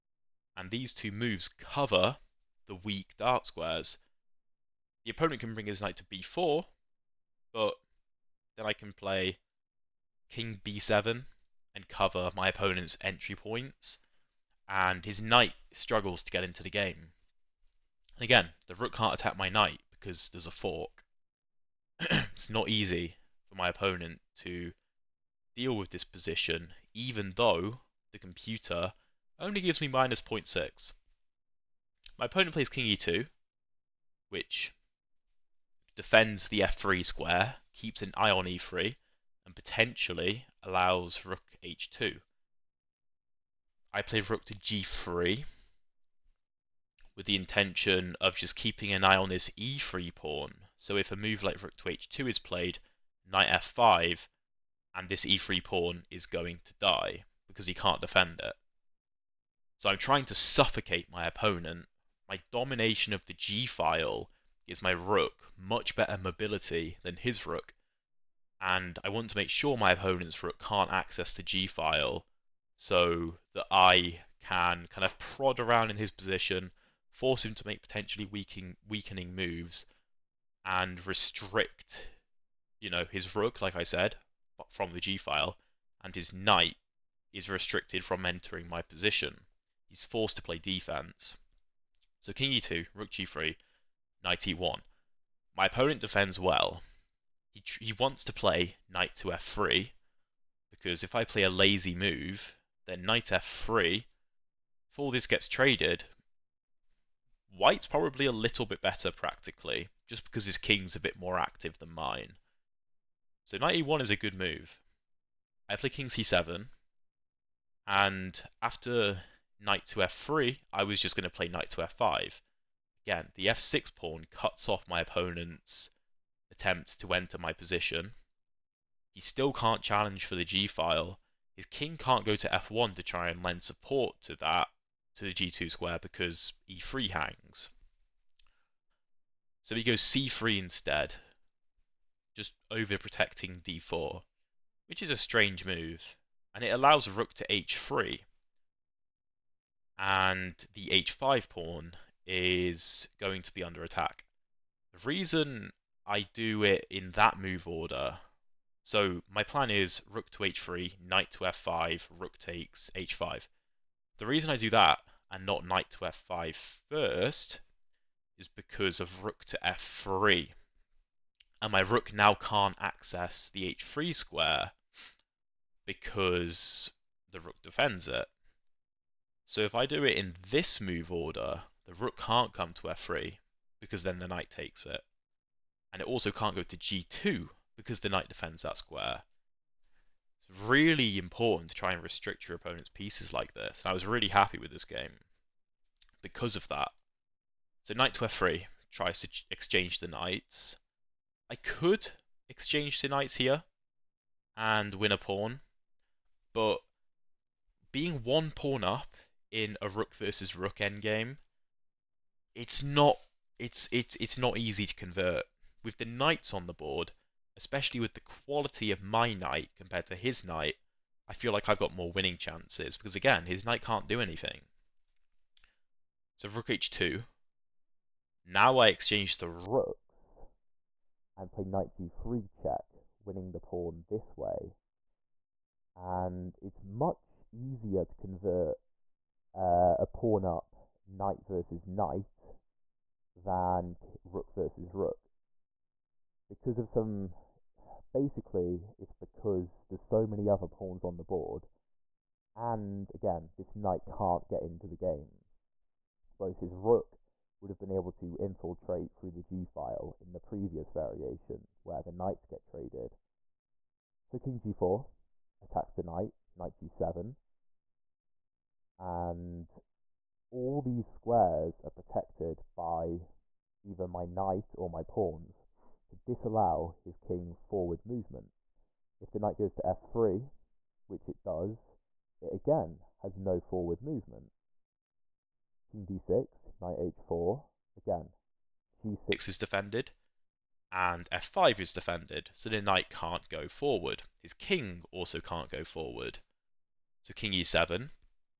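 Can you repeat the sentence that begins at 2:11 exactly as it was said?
His king can't go to f1 to try and lend support to that, to the g2 square, because e3 hangs.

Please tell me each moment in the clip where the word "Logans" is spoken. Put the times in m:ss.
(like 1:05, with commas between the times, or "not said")
not said.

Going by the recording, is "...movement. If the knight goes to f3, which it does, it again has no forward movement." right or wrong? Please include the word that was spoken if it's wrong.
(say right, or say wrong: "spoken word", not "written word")
right.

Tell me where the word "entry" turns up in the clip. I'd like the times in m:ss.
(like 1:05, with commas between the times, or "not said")
0:12.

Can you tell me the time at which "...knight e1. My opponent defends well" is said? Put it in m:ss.
1:34.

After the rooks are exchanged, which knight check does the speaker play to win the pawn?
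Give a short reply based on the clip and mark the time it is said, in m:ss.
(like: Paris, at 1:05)
knight g3, at 3:51.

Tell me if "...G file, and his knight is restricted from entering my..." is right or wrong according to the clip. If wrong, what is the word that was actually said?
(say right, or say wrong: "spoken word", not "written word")
right.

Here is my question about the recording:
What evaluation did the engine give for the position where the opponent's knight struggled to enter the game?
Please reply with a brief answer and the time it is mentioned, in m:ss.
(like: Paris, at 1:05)
-0.6, at 0:29.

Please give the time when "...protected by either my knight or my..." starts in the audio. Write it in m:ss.
4:31.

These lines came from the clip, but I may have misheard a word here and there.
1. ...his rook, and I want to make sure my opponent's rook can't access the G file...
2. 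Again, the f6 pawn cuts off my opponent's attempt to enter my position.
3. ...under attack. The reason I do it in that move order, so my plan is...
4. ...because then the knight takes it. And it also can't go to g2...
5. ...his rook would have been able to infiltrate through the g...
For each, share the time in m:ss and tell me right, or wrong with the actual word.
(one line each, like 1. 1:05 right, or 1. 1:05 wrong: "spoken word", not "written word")
1. 1:07 right
2. 2:03 right
3. 2:33 right
4. 3:03 right
5. 4:16 right.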